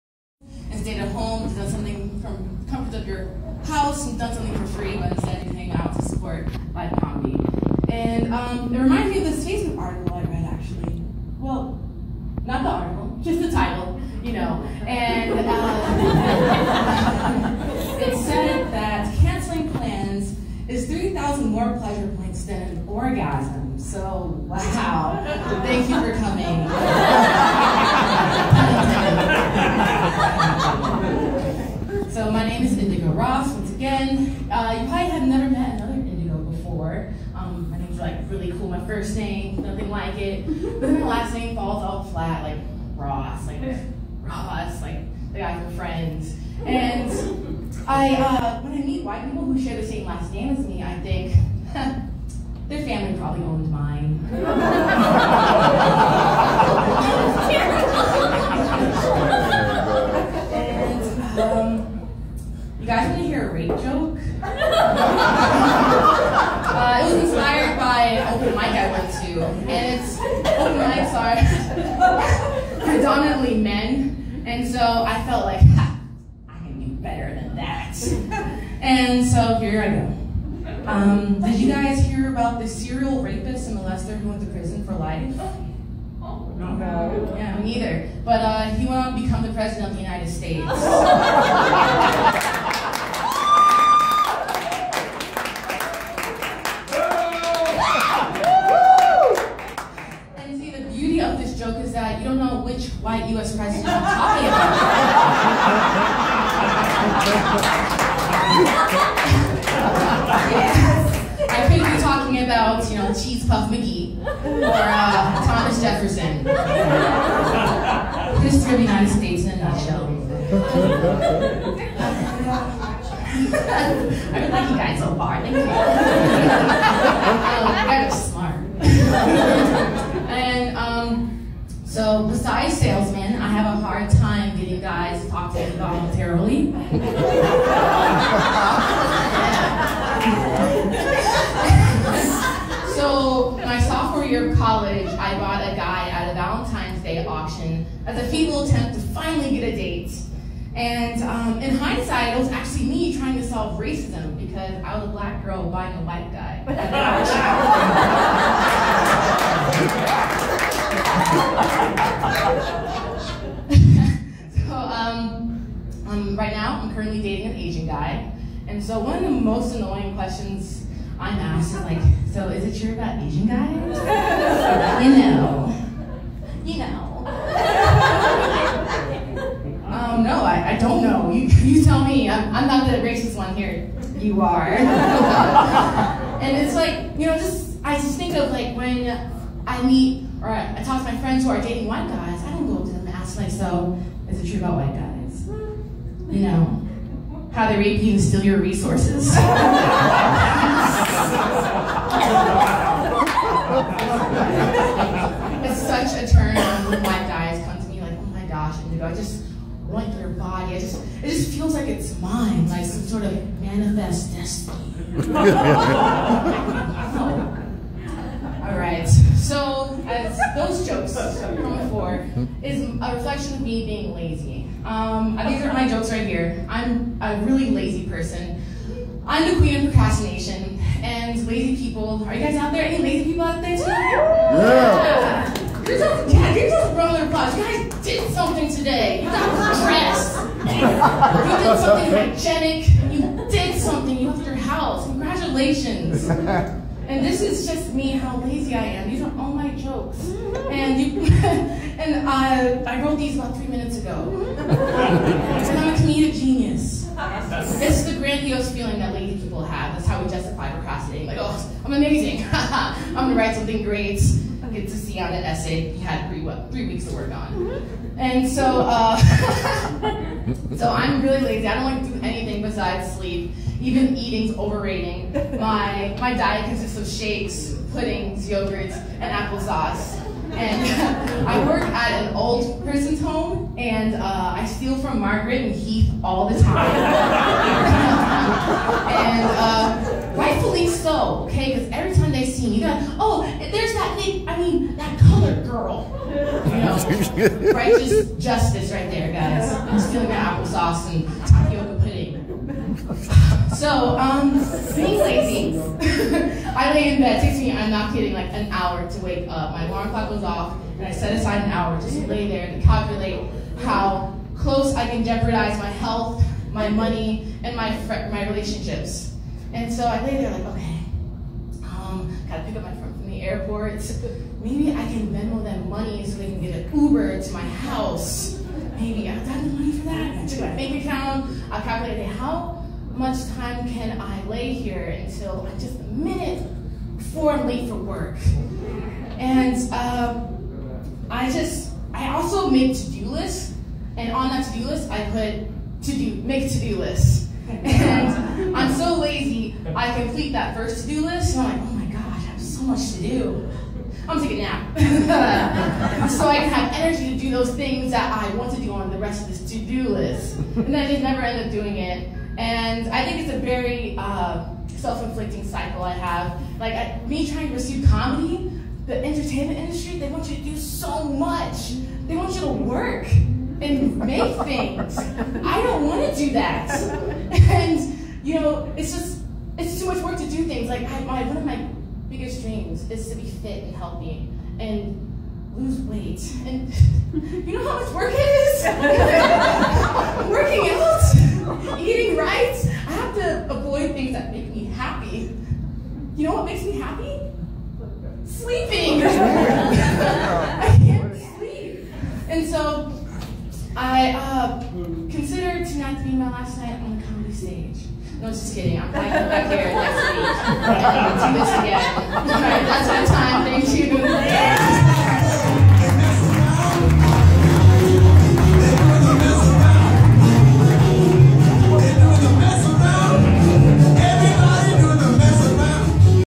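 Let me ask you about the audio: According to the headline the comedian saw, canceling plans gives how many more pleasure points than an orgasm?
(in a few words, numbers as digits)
3,000.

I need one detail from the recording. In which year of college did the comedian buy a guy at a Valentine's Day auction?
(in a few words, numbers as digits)
Sophomore year.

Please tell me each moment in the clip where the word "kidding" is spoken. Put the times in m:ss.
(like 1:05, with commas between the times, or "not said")
5:08, 6:48.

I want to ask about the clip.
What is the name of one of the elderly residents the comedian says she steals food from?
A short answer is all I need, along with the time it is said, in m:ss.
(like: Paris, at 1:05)
Margaret, at 4:45.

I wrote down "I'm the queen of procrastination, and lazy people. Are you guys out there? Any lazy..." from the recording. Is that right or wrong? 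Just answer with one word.
right.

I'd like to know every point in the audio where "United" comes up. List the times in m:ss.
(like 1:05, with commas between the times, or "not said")
1:30, 1:58.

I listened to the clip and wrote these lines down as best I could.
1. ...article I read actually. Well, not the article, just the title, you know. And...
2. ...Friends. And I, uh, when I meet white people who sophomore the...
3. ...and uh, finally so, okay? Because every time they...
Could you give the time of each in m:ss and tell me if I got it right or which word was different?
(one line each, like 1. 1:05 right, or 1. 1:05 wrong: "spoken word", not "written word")
1. 0:09 right
2. 0:45 wrong: "share", not "sophomore"
3. 4:49 wrong: "rightfully", not "finally".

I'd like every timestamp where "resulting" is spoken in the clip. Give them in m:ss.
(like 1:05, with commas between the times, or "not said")
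not said.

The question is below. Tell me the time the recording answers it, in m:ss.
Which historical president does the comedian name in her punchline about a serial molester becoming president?
1:55.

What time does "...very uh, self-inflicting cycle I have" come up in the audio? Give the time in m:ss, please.
6:03.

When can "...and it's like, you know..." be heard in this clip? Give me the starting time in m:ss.
3:04.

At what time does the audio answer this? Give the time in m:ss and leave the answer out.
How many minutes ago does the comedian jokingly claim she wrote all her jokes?
4:13.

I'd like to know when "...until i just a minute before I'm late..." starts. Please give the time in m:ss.
5:35.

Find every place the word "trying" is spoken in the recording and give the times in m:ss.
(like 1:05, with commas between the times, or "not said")
2:33, 6:07.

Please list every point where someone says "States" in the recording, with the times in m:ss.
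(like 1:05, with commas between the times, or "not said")
1:30, 1:59.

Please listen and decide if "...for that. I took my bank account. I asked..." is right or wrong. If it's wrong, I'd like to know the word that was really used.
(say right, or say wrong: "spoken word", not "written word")
wrong: "calculated", not "asked".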